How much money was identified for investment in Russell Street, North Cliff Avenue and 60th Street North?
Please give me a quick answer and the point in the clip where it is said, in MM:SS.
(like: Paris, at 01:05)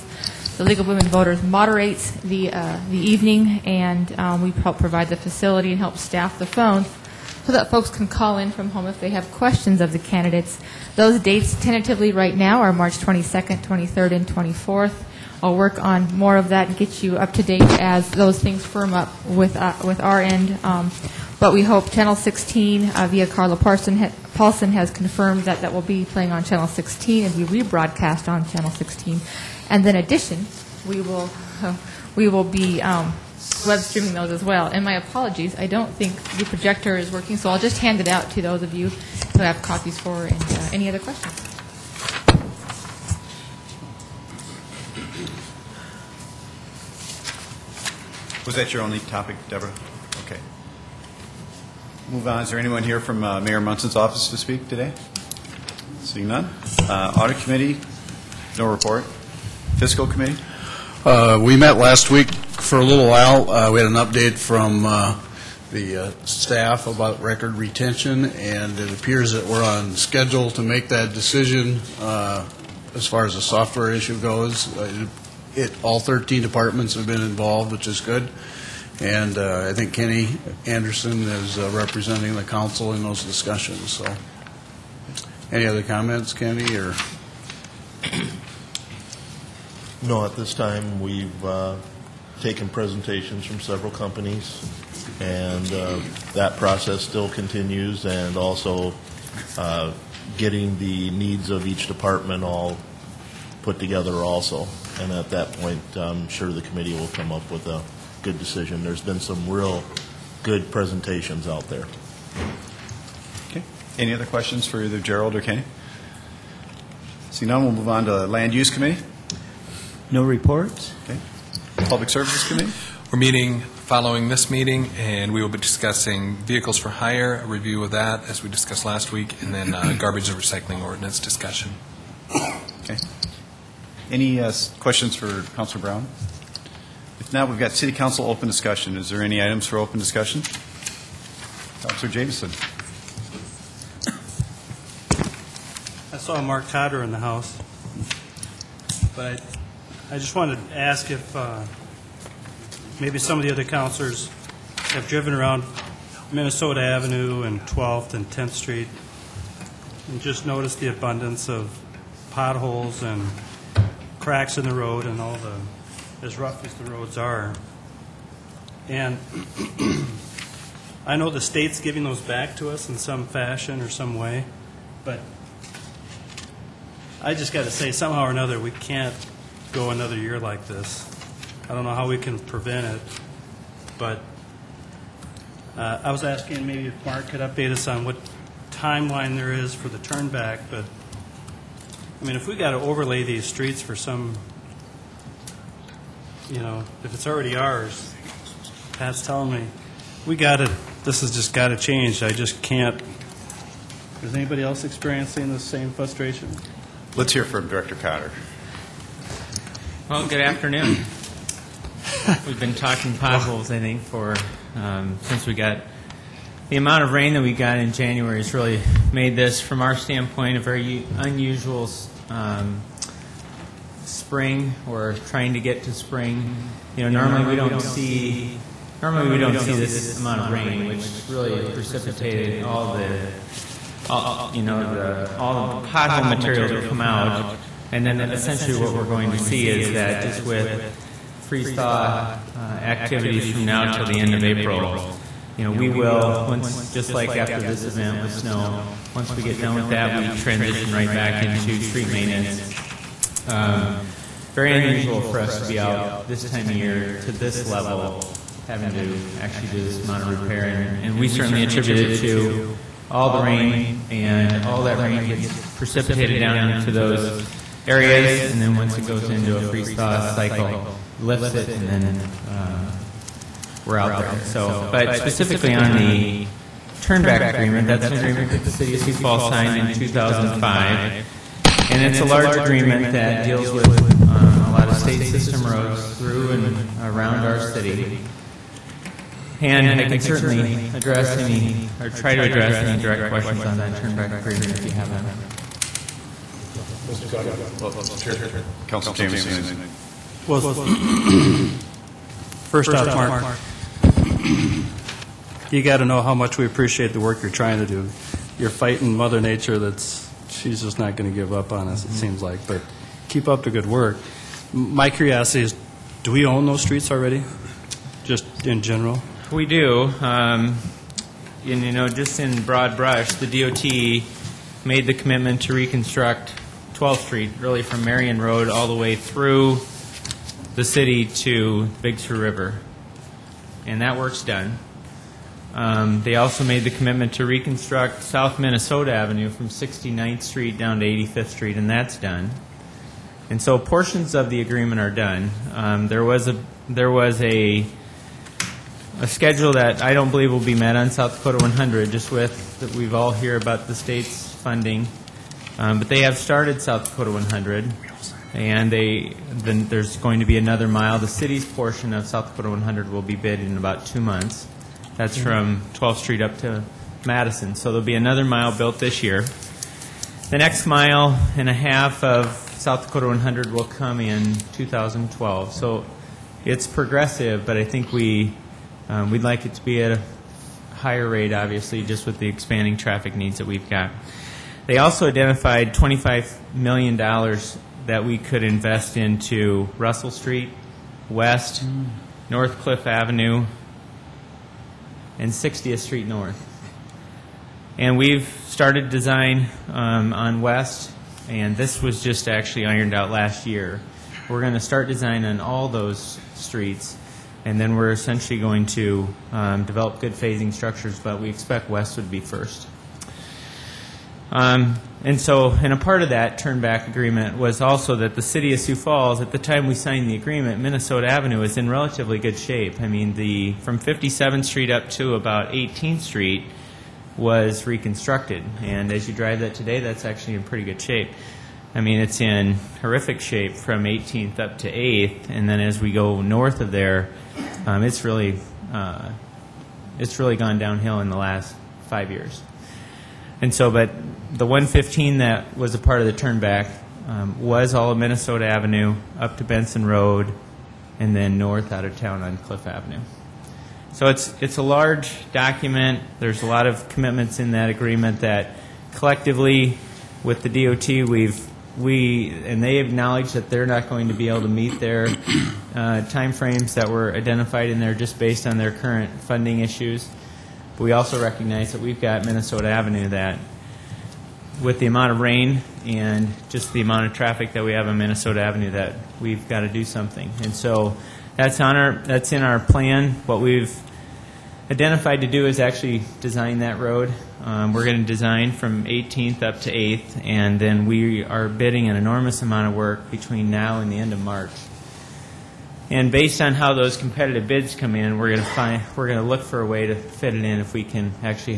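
$25 million, at 06:25.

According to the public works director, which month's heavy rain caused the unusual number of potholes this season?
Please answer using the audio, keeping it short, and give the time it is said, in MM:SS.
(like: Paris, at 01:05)
January, at 03:37.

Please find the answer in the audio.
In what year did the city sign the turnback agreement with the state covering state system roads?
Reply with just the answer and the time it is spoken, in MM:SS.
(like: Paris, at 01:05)
2005, at 04:39.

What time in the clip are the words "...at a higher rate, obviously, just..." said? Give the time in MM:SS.
06:20.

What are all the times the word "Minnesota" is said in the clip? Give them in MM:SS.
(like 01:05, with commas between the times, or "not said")
02:36, 05:38, 07:00, 07:28, 07:52, 07:58.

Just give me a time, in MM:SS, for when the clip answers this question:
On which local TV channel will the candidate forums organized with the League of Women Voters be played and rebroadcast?
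00:26.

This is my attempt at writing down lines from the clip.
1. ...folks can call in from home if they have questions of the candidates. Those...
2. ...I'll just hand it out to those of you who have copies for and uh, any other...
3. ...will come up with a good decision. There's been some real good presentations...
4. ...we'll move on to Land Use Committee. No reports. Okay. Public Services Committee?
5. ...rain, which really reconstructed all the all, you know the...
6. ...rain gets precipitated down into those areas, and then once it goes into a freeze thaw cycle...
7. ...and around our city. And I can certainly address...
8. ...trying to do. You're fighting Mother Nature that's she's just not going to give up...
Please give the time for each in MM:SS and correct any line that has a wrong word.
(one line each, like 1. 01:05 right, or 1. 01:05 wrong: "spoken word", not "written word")
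1. 00:07 right
2. 00:37 right
3. 01:46 right
4. 01:57 right
5. 03:50 wrong: "precipitated", not "reconstructed"
6. 04:25 right
7. 04:46 right
8. 05:07 right.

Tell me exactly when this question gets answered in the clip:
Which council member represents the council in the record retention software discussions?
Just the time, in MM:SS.
01:19.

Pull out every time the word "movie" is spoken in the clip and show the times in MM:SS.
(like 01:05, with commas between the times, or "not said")
not said.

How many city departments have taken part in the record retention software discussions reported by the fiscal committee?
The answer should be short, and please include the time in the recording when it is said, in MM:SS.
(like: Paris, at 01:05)
13, at 01:15.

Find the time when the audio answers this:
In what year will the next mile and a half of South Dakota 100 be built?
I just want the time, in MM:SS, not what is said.
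06:14.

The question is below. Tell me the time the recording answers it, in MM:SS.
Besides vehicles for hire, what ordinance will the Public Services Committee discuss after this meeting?
02:09.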